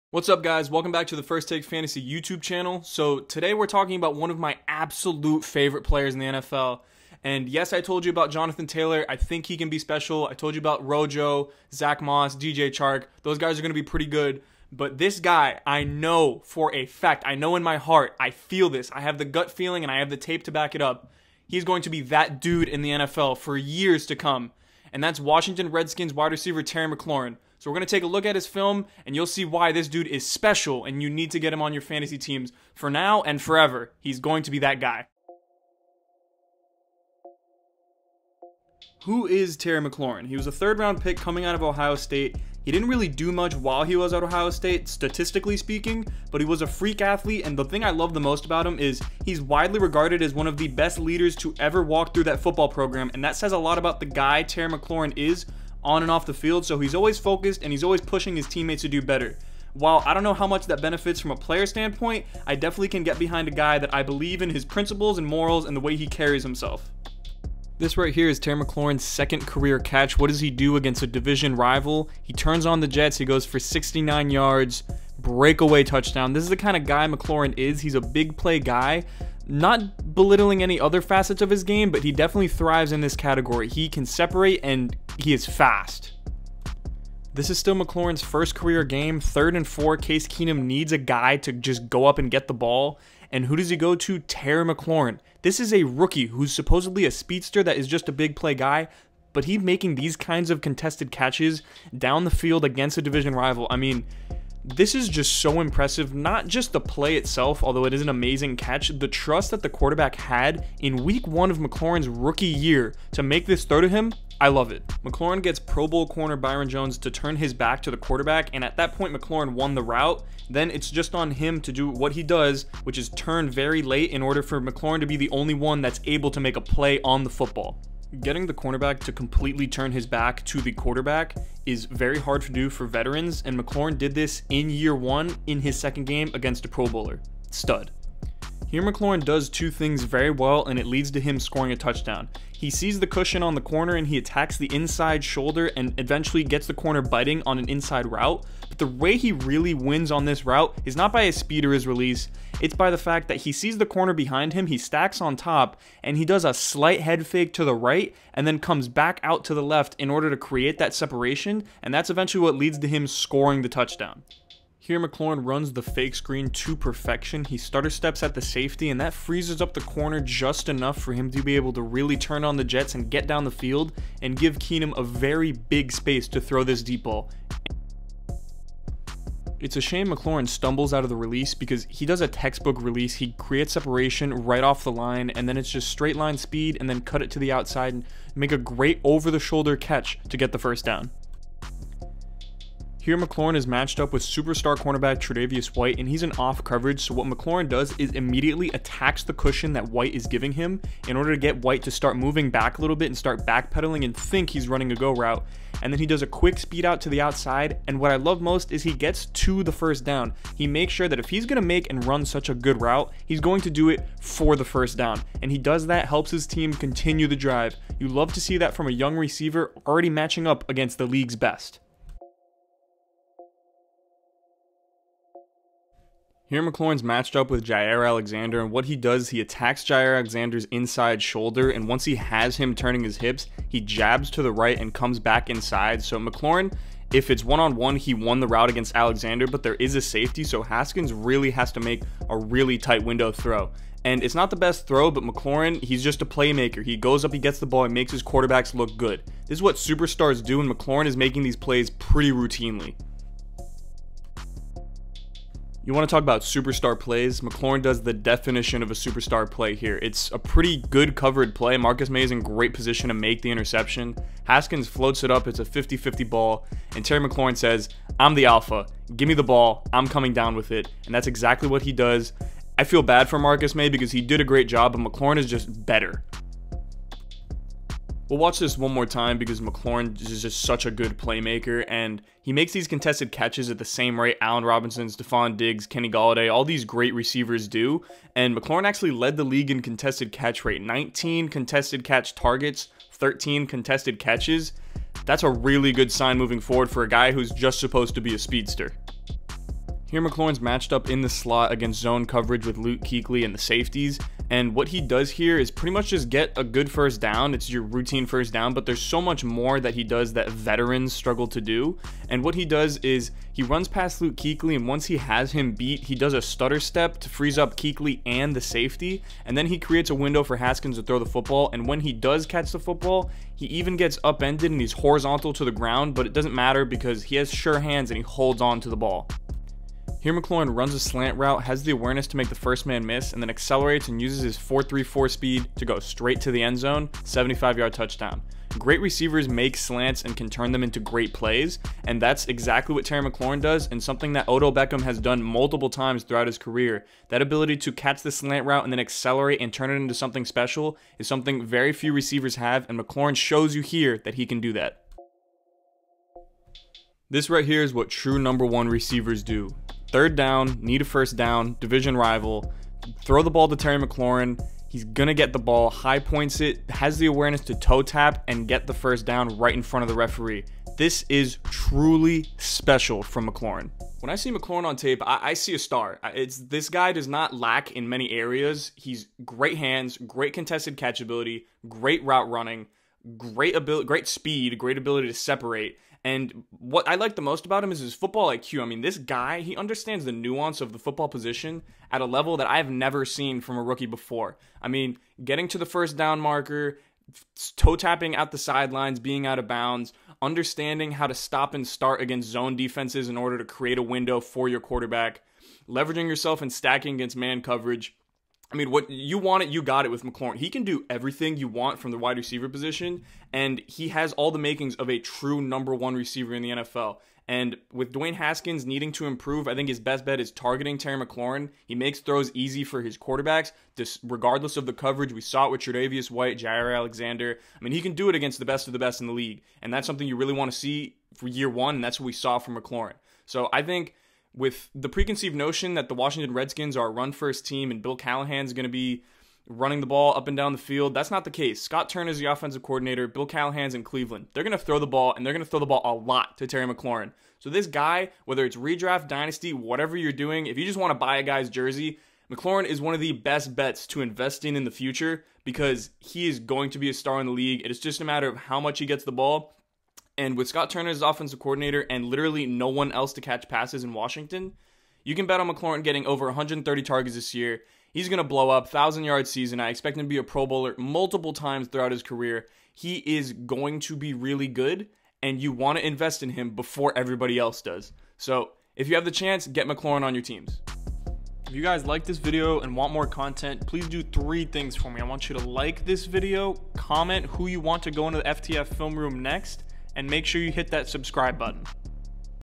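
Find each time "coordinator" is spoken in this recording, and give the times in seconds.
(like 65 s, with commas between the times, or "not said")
442 s, 461 s.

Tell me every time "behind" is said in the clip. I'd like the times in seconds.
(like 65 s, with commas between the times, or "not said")
63 s, 154 s.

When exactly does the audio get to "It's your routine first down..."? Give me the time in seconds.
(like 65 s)
307 s.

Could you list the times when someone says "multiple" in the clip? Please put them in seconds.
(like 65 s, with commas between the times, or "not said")
345 s, 470 s.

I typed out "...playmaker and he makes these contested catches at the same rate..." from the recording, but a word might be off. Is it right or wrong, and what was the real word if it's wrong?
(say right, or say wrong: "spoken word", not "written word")
right.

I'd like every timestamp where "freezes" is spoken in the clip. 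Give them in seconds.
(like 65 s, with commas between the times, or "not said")
169 s, 317 s.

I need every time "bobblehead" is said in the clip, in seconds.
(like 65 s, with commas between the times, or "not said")
not said.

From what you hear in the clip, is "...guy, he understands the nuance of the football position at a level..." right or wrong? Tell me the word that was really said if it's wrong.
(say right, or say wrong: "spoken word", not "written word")
right.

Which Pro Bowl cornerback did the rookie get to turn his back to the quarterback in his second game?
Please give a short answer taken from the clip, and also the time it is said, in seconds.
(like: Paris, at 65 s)
Byron Jones, at 116 s.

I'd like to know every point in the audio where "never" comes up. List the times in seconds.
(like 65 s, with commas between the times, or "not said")
392 s.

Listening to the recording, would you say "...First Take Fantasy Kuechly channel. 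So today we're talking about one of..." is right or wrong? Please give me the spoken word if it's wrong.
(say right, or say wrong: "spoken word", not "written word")
wrong: "YouTube", not "Kuechly".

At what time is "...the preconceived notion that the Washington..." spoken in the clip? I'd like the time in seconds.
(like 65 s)
434 s.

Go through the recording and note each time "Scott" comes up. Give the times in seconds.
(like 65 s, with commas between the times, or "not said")
441 s, 460 s.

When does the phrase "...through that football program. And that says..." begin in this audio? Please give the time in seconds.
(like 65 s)
52 s.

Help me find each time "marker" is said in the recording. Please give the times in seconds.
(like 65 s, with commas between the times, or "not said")
396 s.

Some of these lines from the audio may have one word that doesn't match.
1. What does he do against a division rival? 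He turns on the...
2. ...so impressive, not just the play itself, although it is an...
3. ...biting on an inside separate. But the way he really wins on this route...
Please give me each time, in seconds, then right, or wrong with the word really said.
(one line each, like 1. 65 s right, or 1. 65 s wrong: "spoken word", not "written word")
1. 70 s right
2. 105 s right
3. 147 s wrong: "route", not "separate".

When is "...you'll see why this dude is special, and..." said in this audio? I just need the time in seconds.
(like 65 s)
29 s.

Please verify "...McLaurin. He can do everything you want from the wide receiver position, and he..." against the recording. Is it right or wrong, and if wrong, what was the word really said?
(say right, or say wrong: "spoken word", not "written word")
right.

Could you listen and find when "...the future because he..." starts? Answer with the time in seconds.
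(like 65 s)
454 s.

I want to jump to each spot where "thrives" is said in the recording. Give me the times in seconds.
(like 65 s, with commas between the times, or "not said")
82 s.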